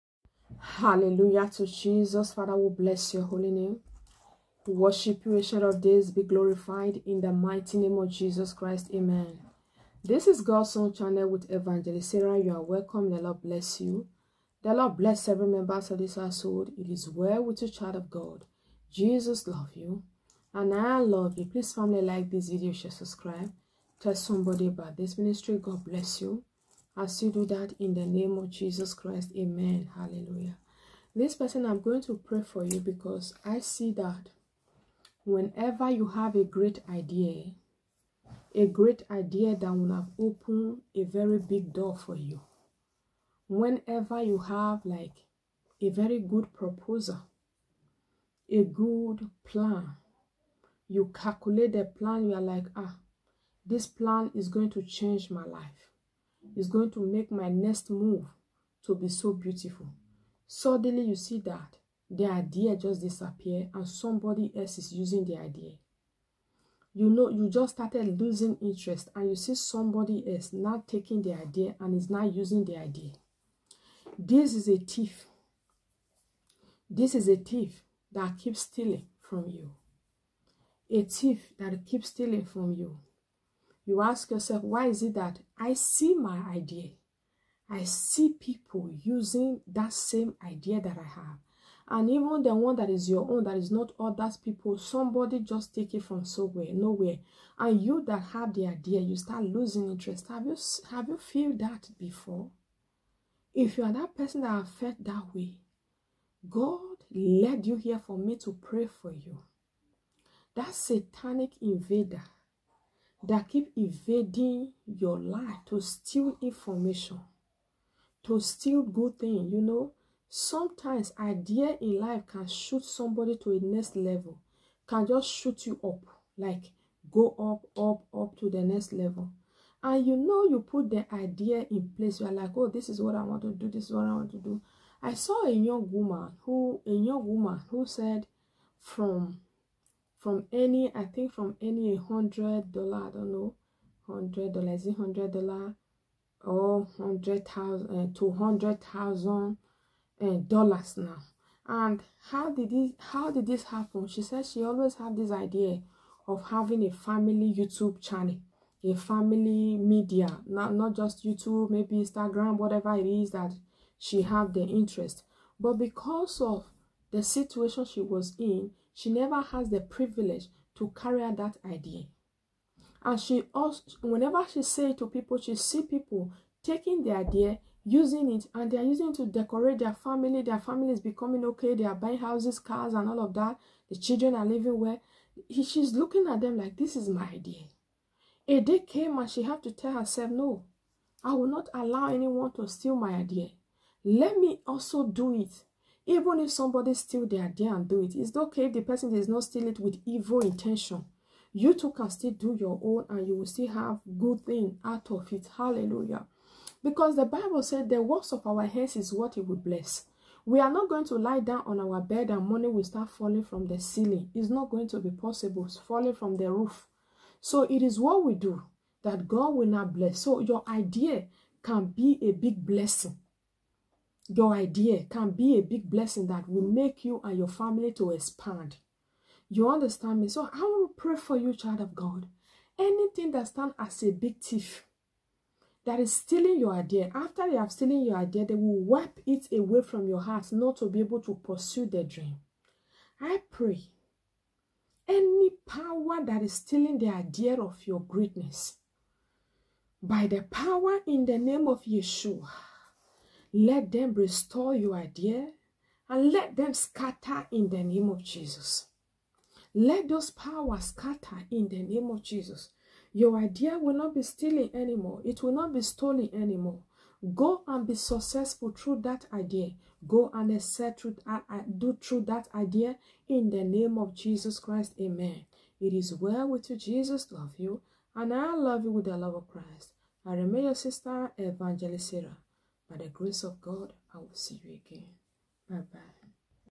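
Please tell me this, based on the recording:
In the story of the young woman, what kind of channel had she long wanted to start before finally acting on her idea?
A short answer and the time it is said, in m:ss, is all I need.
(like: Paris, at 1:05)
family YouTube channel, at 2:36.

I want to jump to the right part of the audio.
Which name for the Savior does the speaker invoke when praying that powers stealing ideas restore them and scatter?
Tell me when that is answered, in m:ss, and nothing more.
4:11.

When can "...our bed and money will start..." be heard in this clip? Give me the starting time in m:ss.
3:31.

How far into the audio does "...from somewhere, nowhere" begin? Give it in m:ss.
1:36.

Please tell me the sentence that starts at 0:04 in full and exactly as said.
worship you, ancient of days, be glorified in the mighty name of Jesus Christ.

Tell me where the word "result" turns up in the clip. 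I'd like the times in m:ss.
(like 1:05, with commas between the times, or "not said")
not said.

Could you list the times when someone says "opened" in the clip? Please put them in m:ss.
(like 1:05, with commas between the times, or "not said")
0:40.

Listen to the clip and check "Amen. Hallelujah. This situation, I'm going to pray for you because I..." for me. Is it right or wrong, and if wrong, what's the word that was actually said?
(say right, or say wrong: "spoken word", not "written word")
wrong: "person", not "situation".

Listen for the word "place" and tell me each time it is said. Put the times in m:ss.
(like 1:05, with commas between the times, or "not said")
2:11.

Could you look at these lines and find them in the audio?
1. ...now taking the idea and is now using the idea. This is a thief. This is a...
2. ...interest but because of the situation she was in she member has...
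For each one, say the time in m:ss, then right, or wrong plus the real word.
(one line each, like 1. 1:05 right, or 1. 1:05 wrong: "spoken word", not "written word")
1. 1:10 right
2. 2:44 wrong: "never", not "member".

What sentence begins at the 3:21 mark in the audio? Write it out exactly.
You two can still do your own and you will still have good thing out of it.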